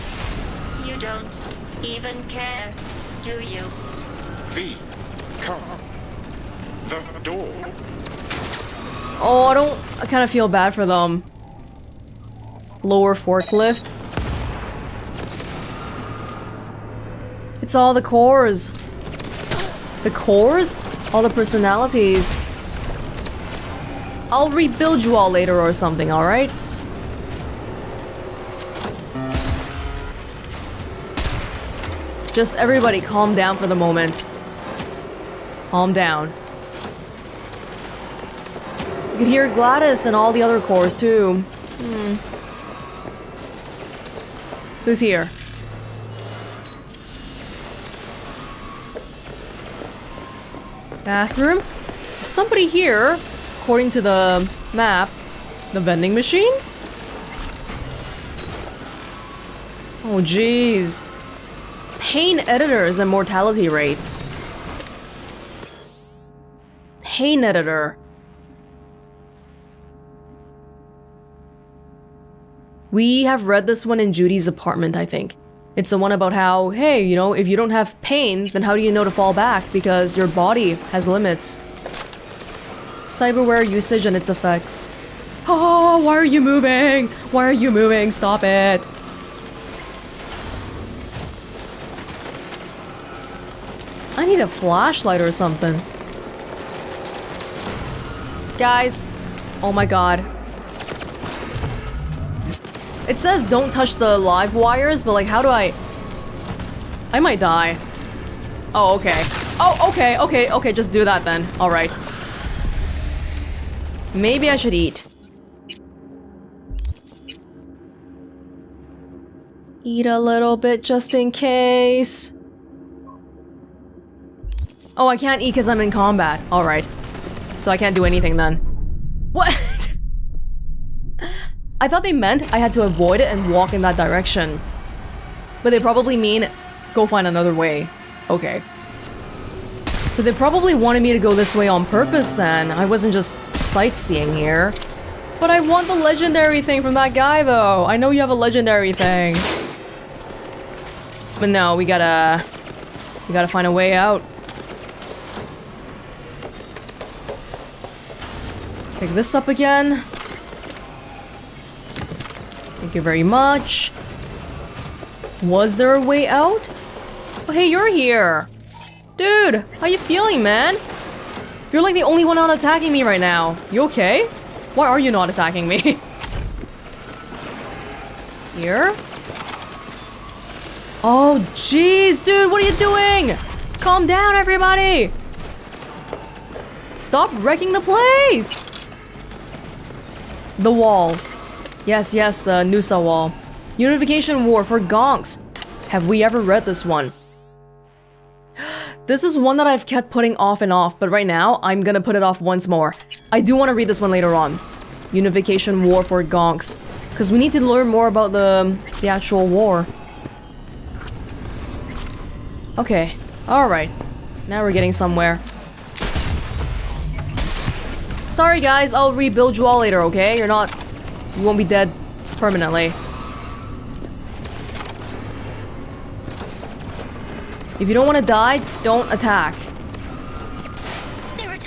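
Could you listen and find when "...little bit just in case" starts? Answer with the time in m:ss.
2:00.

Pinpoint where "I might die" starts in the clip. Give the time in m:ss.
1:47.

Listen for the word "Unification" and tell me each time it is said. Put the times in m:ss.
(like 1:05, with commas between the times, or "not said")
3:13, 3:25.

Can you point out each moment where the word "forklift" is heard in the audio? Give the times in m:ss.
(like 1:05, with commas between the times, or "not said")
0:13.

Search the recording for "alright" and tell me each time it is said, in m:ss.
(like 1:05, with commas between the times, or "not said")
0:26, 1:51, 2:06, 3:33.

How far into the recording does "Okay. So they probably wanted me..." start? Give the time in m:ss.
2:18.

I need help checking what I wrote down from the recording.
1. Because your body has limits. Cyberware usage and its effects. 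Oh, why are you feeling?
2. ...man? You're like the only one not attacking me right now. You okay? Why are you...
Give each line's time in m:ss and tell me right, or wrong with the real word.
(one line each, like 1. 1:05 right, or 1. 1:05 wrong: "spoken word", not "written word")
1. 1:19 wrong: "moving", not "feeling"
2. 2:50 right.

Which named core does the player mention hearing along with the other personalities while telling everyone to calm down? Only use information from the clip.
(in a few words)
Gladys.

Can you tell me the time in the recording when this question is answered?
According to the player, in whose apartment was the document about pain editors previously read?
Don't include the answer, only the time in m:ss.
1:14.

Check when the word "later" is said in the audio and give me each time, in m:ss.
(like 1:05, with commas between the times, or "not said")
0:25, 3:24, 3:39.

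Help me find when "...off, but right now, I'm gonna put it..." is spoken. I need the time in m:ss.
3:20.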